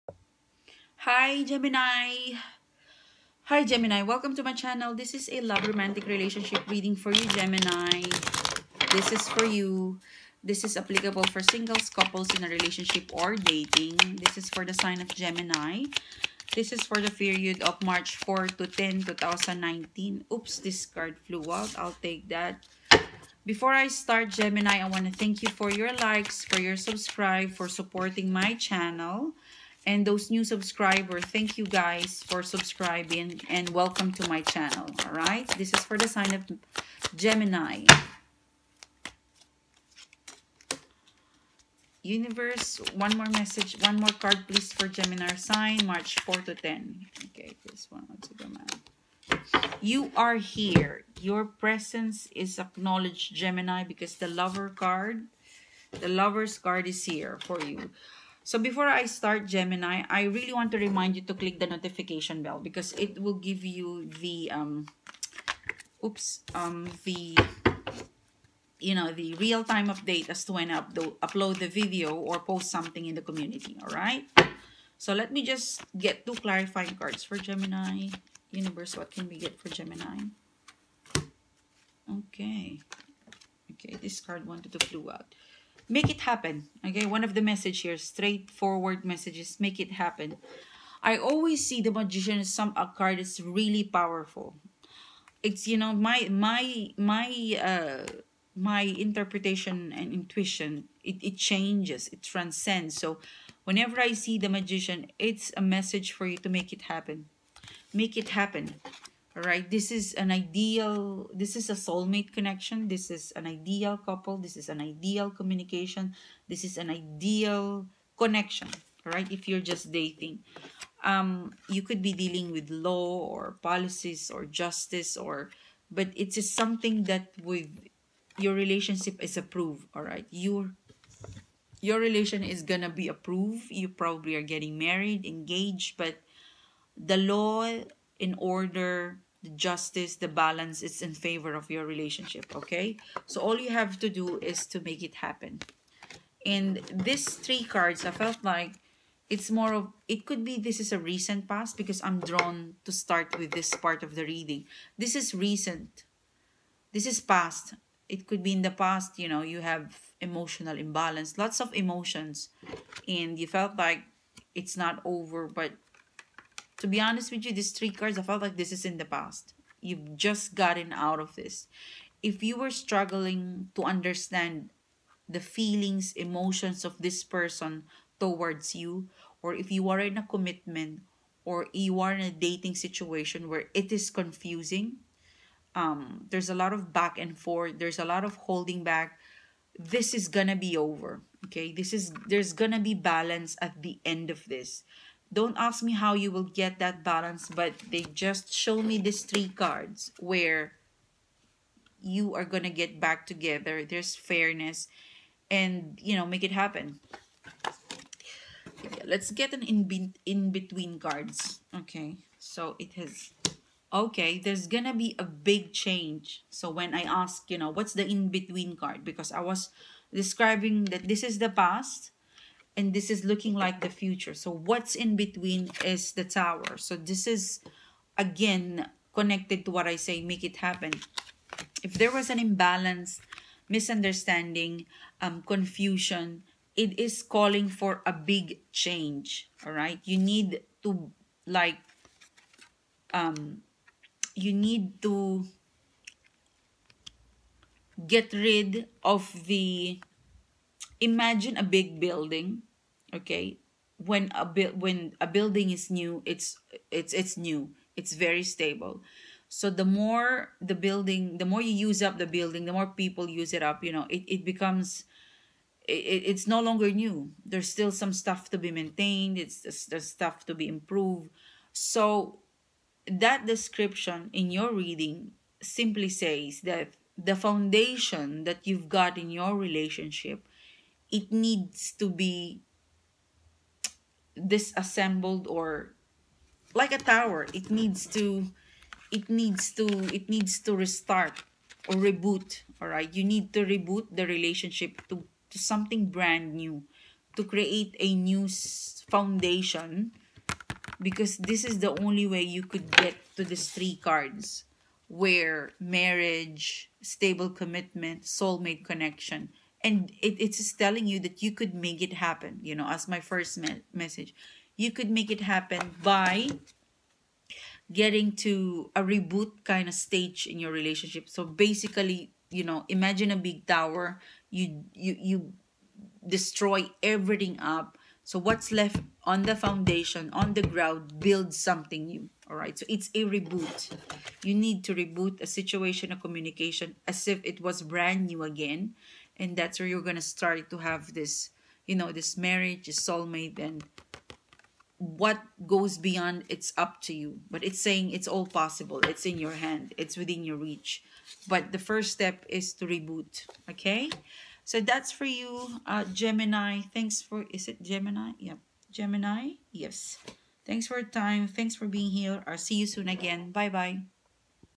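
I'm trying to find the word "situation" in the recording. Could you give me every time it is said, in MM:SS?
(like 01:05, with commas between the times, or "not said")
03:02, 05:35.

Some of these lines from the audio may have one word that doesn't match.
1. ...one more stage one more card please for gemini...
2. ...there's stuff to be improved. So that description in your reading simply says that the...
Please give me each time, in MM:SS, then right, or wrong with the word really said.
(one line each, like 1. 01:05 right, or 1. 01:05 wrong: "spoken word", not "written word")
1. 00:42 wrong: "message", not "stage"
2. 04:29 right.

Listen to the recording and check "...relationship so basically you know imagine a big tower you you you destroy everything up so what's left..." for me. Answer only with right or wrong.
right.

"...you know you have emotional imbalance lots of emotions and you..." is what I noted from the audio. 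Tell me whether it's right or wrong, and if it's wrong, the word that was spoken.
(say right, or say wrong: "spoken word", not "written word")
right.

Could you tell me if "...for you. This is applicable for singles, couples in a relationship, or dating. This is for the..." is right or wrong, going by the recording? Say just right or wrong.
right.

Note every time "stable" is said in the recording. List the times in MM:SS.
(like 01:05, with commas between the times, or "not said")
04:18, 05:07.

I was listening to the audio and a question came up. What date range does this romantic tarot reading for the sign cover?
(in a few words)
March 4 to 10, 2019.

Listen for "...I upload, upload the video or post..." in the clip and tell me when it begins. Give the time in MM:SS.
01:10.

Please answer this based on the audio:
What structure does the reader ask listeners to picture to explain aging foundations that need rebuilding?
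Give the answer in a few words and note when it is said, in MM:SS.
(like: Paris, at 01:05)
A big building, at 04:11.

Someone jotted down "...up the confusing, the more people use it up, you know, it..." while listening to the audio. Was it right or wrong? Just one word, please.
wrong.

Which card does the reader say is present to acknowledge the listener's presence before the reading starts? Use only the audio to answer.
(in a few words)
The Lovers.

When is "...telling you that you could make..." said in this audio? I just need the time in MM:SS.
05:10.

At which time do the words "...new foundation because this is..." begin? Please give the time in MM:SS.
04:58.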